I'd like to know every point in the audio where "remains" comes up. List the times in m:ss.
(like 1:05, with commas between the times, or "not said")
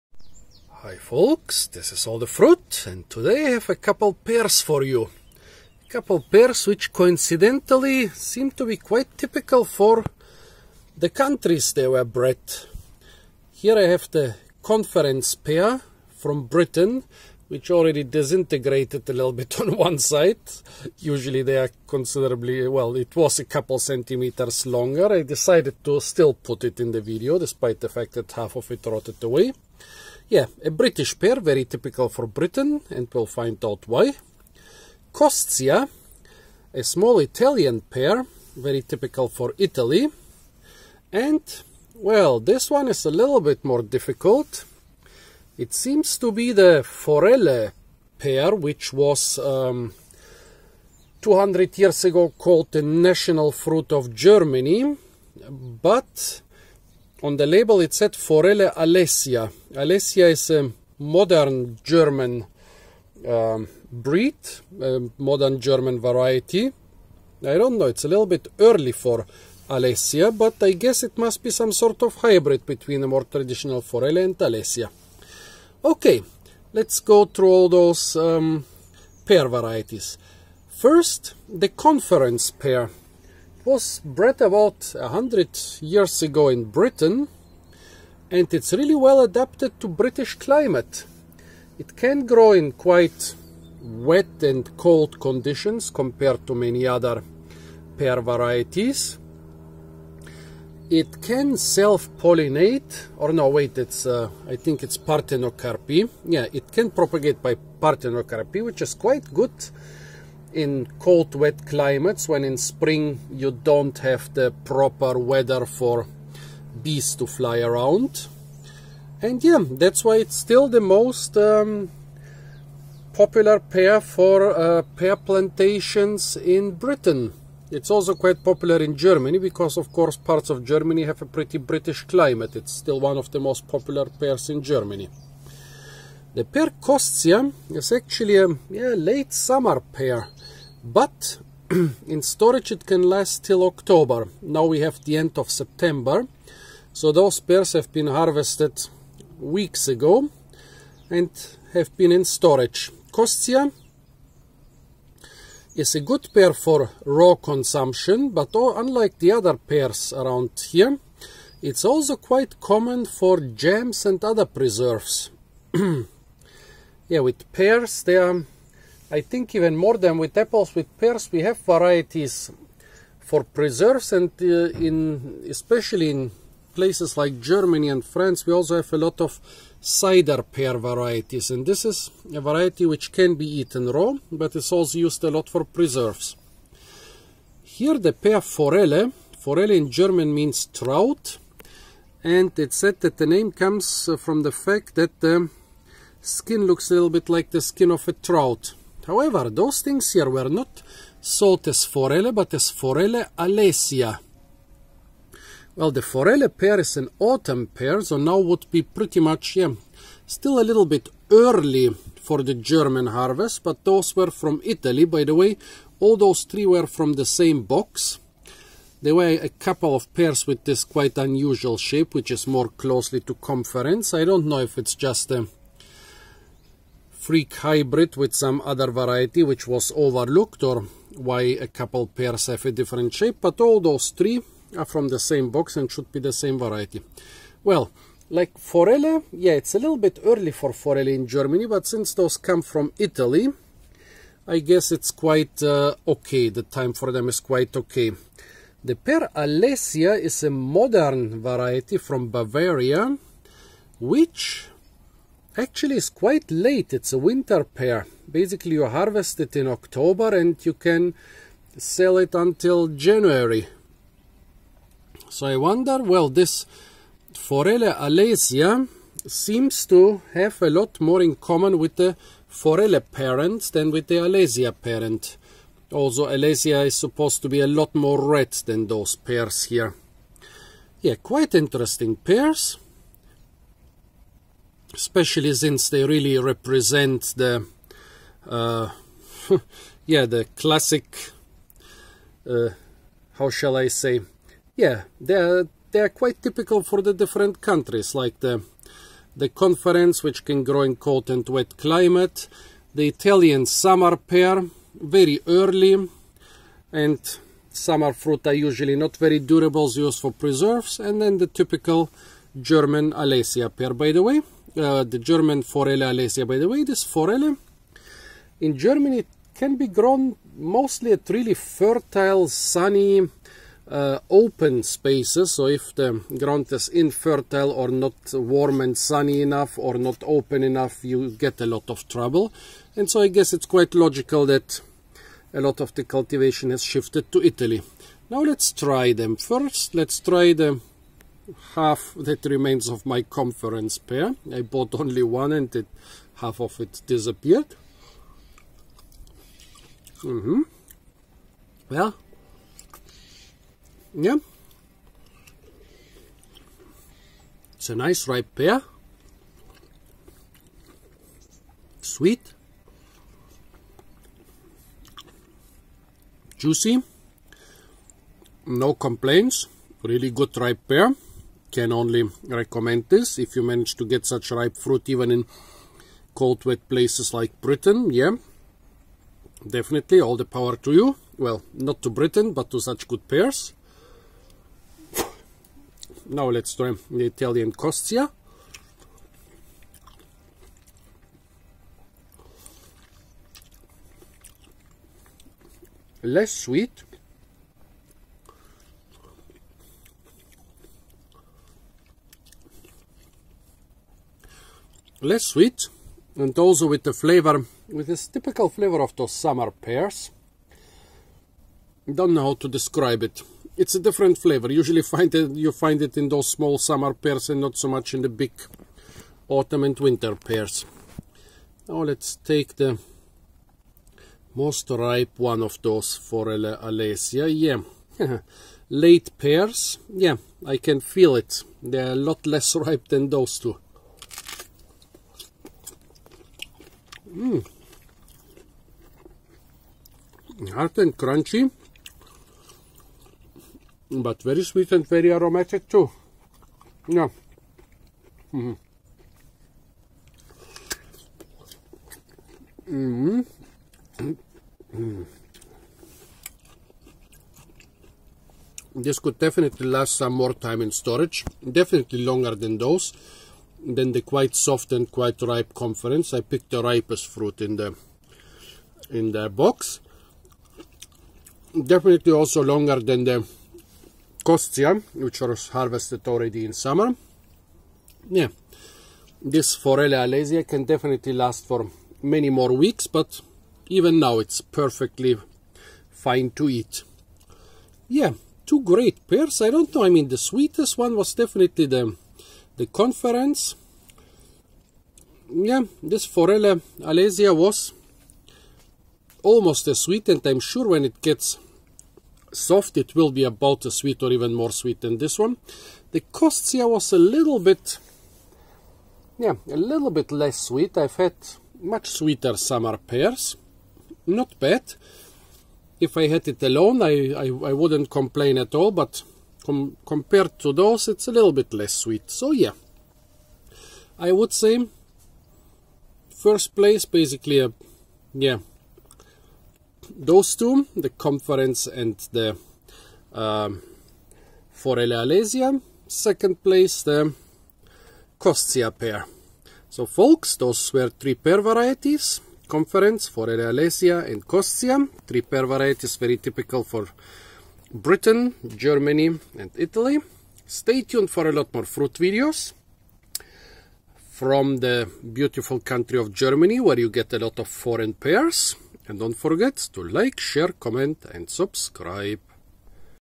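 5:42.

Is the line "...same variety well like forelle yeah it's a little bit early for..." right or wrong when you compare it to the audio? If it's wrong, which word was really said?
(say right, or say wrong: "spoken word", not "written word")
right.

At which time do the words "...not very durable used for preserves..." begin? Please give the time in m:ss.
5:08.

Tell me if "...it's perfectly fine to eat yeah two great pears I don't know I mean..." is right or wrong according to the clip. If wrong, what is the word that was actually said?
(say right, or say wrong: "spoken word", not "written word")
right.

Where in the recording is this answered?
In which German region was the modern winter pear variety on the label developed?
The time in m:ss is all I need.
4:12.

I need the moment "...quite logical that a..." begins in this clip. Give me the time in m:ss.
5:33.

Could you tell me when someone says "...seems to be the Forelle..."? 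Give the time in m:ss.
0:45.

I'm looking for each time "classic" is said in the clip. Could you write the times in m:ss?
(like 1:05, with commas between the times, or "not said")
4:50.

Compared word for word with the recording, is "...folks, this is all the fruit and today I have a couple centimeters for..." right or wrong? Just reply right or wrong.
wrong.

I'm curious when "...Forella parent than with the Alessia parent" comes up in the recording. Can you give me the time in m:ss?
4:32.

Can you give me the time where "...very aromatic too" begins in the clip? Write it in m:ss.
7:25.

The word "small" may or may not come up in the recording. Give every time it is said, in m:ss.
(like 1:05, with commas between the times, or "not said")
0:36, 6:56.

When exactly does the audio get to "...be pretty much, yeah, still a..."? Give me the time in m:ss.
3:28.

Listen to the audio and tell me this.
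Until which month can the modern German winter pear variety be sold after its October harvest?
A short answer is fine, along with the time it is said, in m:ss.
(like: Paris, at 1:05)
January, at 4:22.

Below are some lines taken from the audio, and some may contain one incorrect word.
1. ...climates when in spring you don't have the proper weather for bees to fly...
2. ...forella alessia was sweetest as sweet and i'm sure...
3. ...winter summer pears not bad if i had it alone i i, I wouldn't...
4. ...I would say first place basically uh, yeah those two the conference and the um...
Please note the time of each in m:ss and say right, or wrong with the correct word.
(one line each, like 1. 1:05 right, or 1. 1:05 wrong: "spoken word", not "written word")
1. 1:51 right
2. 8:16 wrong: "almost", not "sweetest"
3. 8:32 wrong: "sweeter", not "winter"
4. 8:44 right.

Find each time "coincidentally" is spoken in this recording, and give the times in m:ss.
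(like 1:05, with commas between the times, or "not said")
0:06.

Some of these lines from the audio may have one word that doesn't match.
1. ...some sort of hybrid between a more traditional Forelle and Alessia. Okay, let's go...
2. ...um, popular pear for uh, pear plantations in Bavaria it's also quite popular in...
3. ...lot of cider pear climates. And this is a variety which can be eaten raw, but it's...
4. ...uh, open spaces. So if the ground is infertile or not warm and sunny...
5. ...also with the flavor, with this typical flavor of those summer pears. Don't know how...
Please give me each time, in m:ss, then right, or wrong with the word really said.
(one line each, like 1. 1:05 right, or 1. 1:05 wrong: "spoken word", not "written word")
1. 1:11 right
2. 2:01 wrong: "Britain", not "Bavaria"
3. 2:58 wrong: "varieties", not "climates"
4. 5:23 right
5. 6:46 right.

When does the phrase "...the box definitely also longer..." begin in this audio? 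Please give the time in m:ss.
7:49.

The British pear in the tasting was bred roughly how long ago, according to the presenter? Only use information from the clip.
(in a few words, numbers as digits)
100 years.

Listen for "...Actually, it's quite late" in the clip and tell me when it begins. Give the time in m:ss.
4:15.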